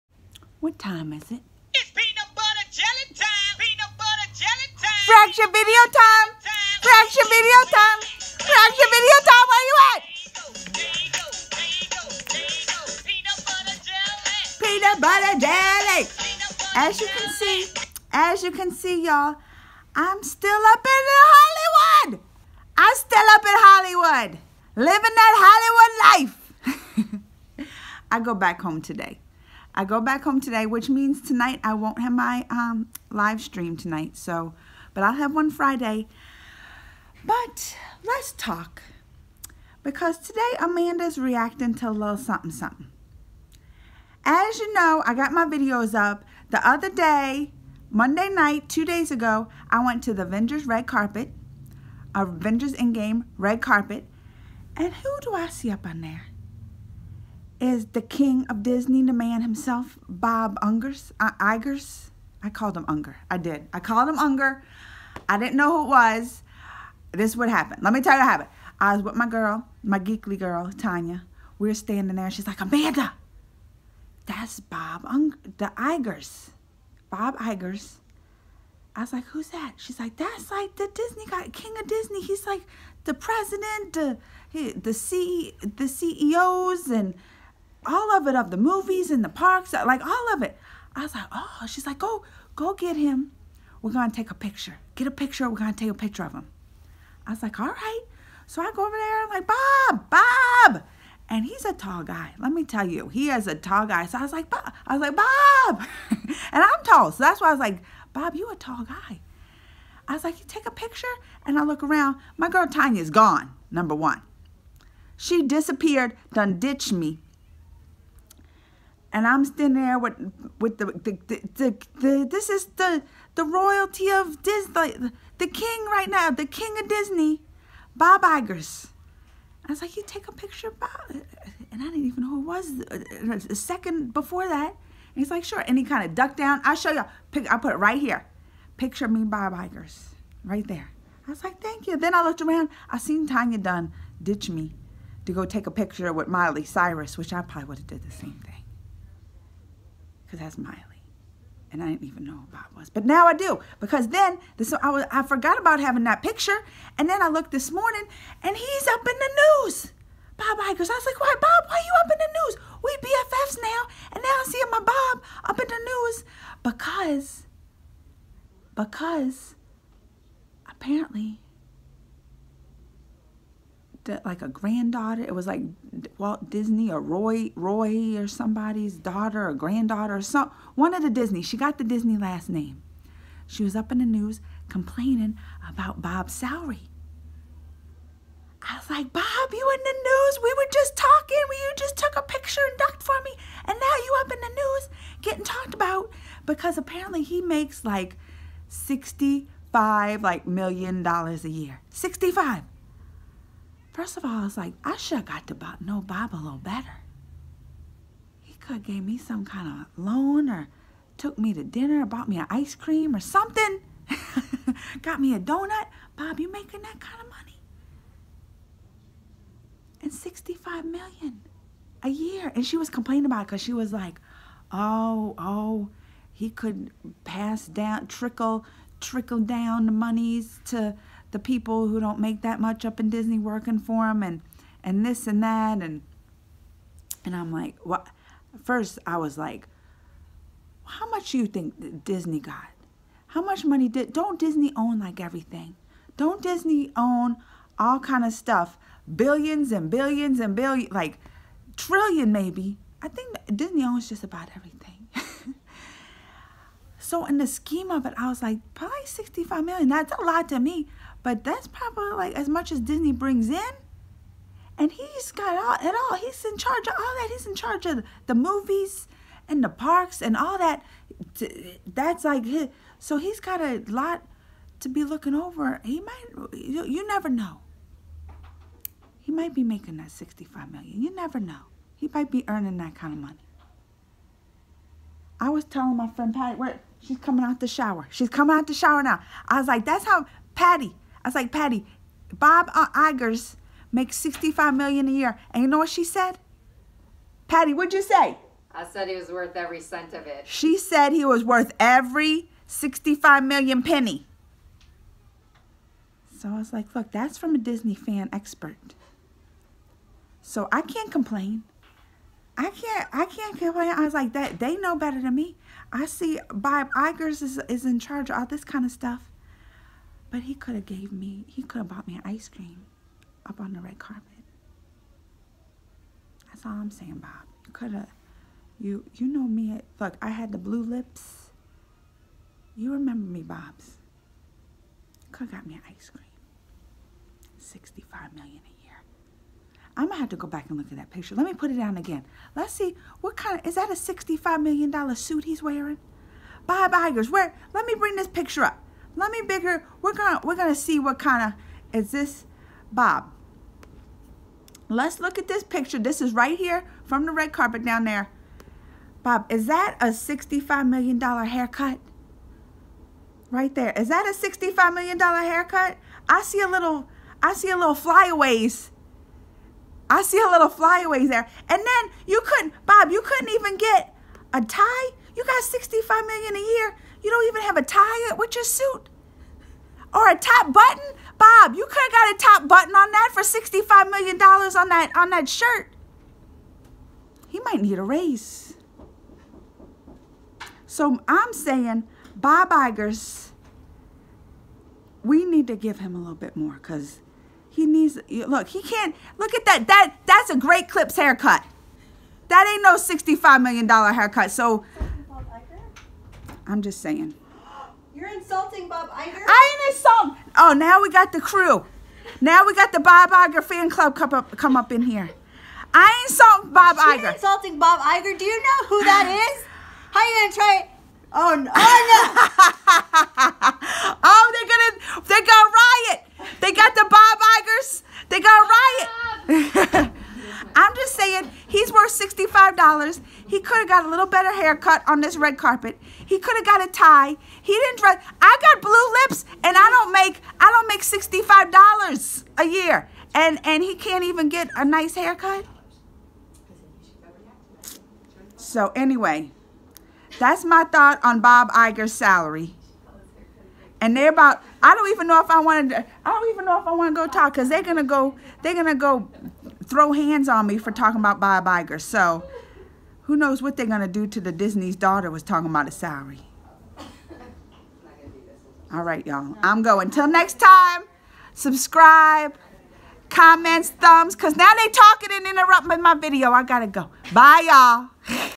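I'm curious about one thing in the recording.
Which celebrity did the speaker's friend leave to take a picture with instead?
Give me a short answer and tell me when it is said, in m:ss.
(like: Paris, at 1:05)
Miley Cyrus, at 2:26.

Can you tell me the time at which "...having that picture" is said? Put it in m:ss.
2:35.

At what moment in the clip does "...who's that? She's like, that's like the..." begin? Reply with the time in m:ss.
1:19.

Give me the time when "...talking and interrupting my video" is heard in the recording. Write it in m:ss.
7:54.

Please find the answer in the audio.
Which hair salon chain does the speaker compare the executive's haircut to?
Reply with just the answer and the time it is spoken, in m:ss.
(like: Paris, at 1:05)
Great Clips, at 6:40.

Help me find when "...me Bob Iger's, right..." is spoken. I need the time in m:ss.
2:19.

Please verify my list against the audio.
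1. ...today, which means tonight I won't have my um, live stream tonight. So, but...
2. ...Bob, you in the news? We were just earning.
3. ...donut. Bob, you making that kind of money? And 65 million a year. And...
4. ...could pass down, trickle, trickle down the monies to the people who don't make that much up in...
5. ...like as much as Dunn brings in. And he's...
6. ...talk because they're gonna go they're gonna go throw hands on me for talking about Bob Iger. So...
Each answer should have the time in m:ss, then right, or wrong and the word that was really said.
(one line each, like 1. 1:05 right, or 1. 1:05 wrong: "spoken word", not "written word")
1. 0:30 right
2. 3:09 wrong: "talking", not "earning"
3. 3:35 right
4. 3:46 right
5. 4:22 wrong: "Disney", not "Dunn"
6. 7:37 right.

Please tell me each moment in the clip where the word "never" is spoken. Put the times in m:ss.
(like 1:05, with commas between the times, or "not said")
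4:37, 4:41.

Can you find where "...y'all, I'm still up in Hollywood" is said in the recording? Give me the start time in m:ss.
0:19.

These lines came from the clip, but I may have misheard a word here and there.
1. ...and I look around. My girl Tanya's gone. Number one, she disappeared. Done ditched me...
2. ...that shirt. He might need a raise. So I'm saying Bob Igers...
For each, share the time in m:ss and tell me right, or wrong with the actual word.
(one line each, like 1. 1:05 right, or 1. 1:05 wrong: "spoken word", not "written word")
1. 1:51 right
2. 6:25 right.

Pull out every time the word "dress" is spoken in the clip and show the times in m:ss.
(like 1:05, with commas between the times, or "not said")
7:17.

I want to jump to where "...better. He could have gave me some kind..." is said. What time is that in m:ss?
3:26.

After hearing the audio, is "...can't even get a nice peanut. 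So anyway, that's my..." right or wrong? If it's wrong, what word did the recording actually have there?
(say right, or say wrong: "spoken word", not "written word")
wrong: "haircut", not "peanut".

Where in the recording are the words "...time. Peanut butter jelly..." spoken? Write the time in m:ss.
0:03.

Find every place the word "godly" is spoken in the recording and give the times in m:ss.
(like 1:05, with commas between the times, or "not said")
not said.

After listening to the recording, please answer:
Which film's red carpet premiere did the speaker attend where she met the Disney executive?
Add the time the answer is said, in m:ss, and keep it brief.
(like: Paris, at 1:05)
Avengers Endgame, at 0:52.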